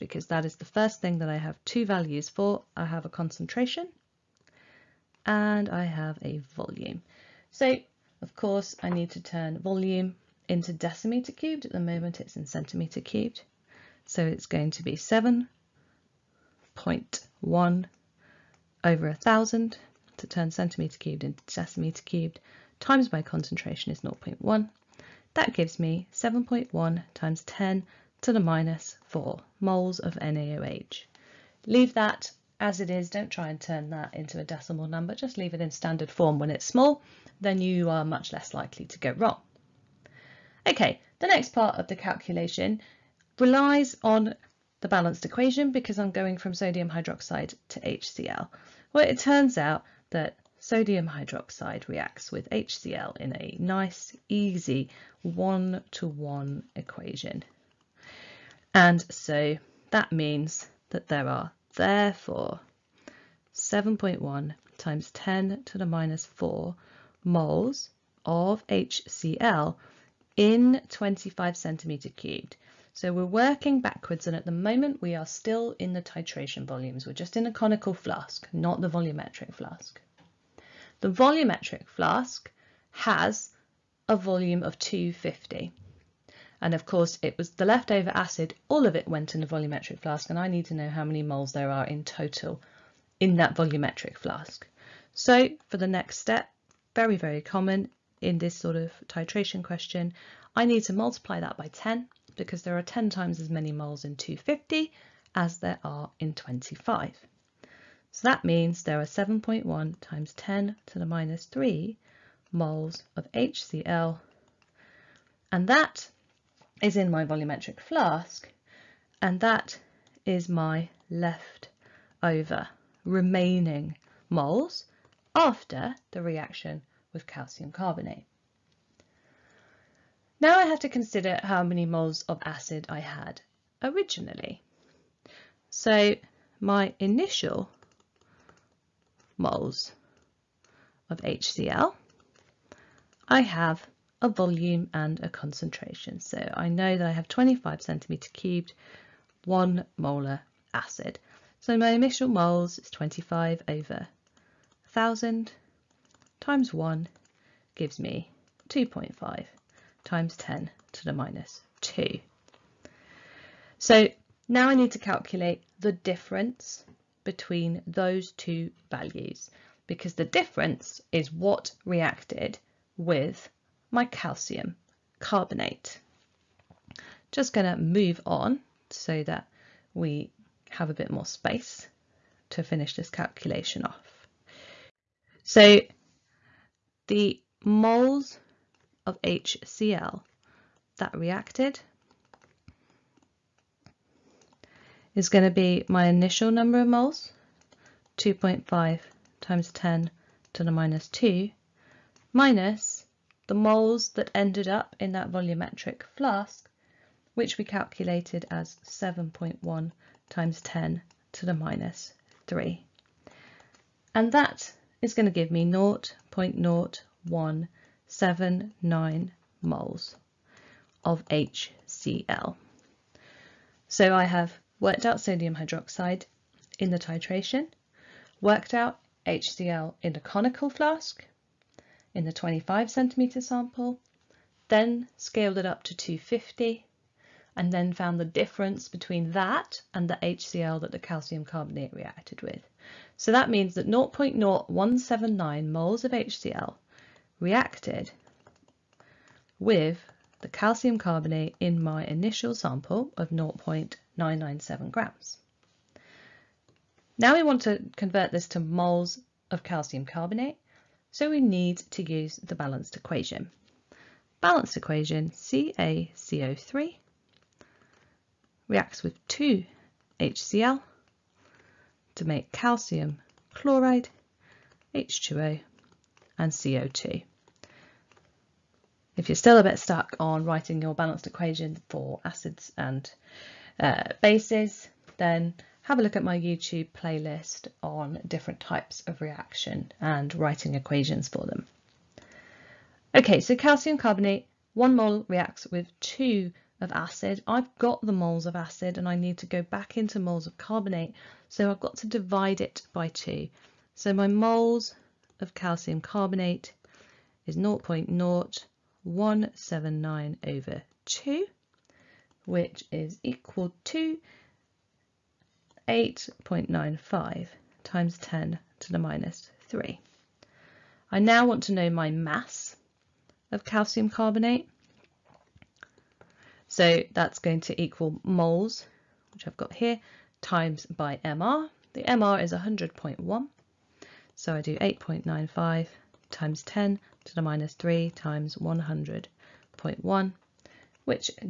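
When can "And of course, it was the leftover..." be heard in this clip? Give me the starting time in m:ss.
1:26.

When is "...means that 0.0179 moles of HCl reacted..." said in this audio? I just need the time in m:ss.
4:03.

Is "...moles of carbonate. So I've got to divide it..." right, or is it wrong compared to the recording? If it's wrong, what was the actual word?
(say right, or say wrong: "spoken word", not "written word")
right.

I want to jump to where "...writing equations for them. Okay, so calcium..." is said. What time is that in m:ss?
4:50.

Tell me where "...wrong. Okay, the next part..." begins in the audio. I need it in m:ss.
0:39.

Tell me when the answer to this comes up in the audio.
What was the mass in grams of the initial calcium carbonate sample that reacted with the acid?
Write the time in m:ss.
4:13.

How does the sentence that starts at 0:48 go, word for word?
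Well, it turns out that sodium hydroxide reacts with HCl in a nice, easy one-to-one -one equation.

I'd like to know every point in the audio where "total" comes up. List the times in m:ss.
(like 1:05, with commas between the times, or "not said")
1:32.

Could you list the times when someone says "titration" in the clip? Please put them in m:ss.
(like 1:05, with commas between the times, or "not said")
1:16, 1:39, 3:46.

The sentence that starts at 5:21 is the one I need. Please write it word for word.
I now want to know my mass of calcium carbonate.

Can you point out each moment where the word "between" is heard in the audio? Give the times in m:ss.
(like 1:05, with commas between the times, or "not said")
2:47, 3:58.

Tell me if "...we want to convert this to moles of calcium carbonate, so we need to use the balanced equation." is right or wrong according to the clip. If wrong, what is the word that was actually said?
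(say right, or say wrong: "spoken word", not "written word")
right.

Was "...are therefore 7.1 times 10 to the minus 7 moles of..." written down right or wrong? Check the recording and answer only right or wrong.
wrong.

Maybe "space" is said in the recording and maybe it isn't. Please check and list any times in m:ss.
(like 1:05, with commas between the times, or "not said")
3:01.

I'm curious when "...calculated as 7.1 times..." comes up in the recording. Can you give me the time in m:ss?
3:27.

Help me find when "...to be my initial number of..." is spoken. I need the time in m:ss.
3:15.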